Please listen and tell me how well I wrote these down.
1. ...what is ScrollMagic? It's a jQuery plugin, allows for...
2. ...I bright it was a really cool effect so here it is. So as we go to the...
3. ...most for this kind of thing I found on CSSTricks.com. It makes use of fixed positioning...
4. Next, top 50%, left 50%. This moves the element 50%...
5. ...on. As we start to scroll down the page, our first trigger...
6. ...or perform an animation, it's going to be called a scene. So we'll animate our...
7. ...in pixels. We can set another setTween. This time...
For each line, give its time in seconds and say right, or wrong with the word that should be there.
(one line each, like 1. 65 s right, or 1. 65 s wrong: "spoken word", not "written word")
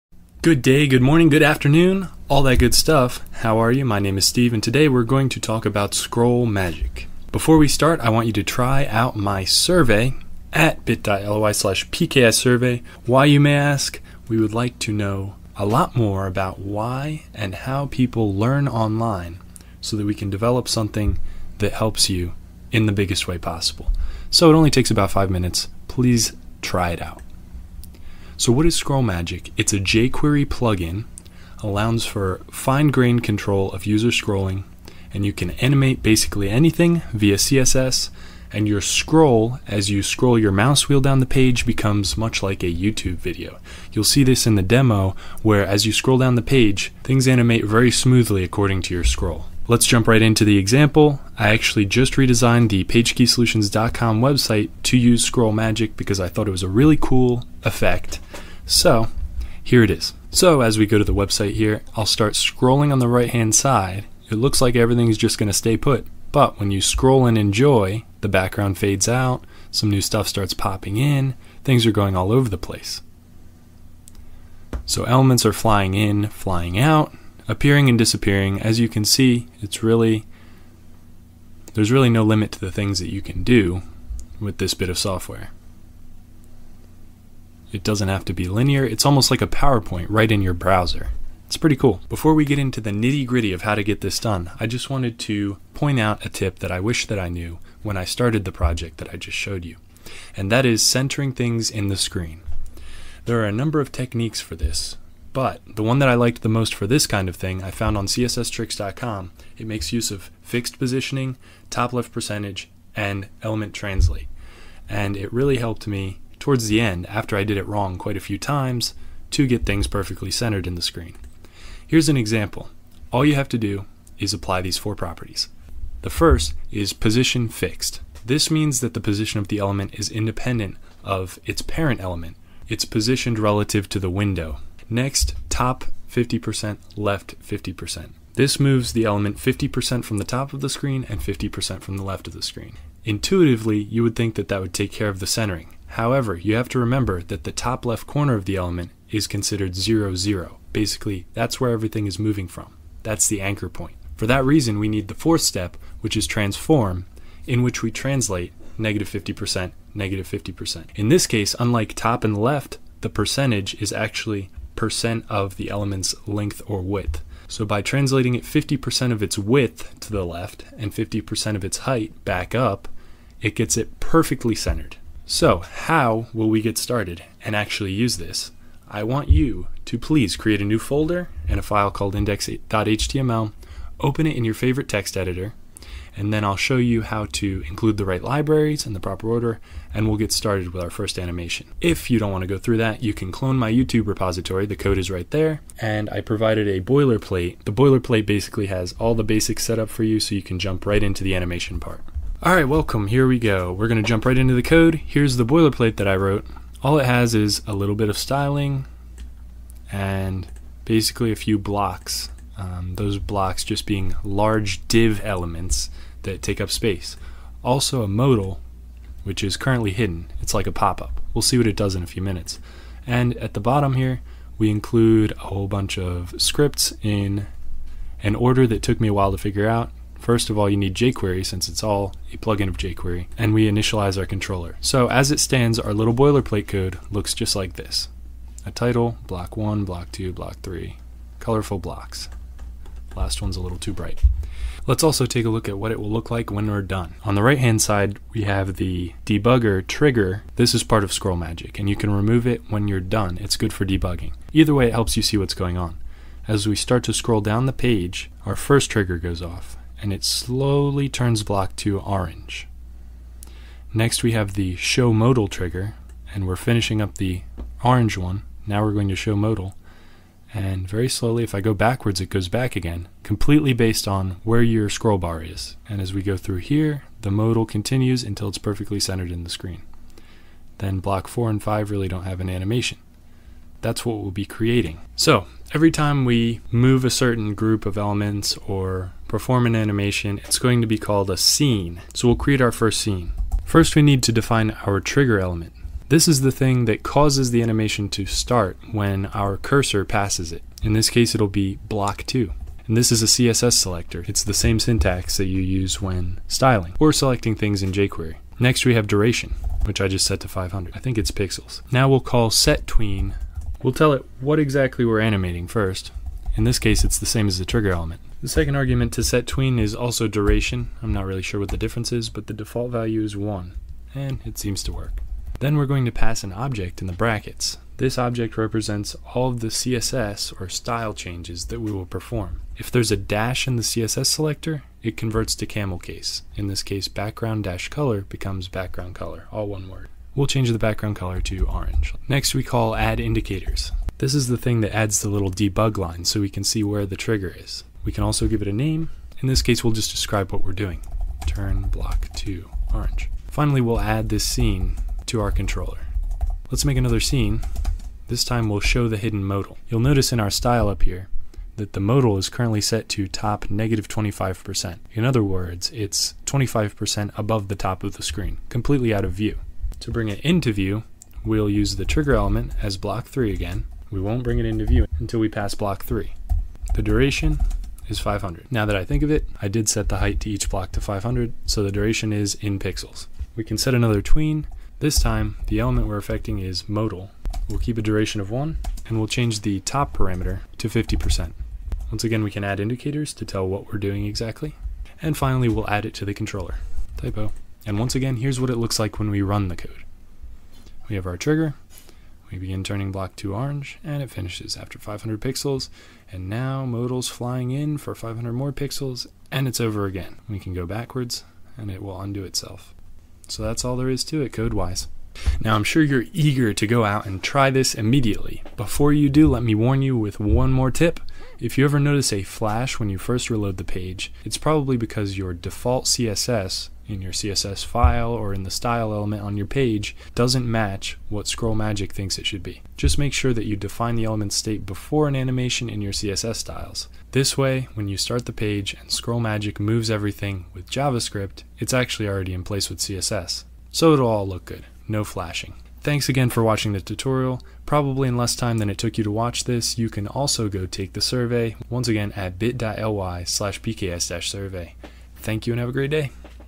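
1. 28 s right
2. 56 s wrong: "thought", not "bright"
3. 106 s right
4. 134 s right
5. 255 s right
6. 288 s wrong: "create", not "animate"
7. 382 s wrong: "tween", not "setTween".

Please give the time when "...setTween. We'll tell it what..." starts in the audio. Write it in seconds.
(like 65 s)
312 s.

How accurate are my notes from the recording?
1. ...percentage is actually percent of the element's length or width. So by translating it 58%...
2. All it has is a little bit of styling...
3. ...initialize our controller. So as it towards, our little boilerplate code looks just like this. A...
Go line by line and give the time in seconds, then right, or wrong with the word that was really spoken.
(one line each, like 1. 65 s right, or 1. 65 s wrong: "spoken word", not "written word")
1. 163 s wrong: "50", not "58"
2. 206 s right
3. 233 s wrong: "stands", not "towards".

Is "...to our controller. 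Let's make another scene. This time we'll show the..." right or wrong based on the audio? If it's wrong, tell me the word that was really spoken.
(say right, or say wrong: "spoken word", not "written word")
right.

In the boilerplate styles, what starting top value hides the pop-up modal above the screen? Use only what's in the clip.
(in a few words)
-25%.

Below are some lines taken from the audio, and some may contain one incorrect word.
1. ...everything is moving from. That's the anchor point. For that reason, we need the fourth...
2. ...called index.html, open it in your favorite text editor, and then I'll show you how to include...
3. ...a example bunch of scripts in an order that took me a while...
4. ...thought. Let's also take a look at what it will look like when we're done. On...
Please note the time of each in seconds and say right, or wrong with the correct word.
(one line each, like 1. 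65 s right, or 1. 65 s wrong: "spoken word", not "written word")
1. 151 s right
2. 181 s right
3. 225 s wrong: "whole", not "example"
4. 243 s wrong: "bright", not "thought".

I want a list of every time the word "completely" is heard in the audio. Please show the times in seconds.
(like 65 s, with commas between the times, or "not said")
273 s, 368 s.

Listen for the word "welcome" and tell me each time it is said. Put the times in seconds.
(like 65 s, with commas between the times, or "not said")
202 s.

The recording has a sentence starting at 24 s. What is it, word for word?
So it only takes about five minutes.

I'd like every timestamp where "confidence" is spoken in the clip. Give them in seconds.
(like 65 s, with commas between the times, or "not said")
not said.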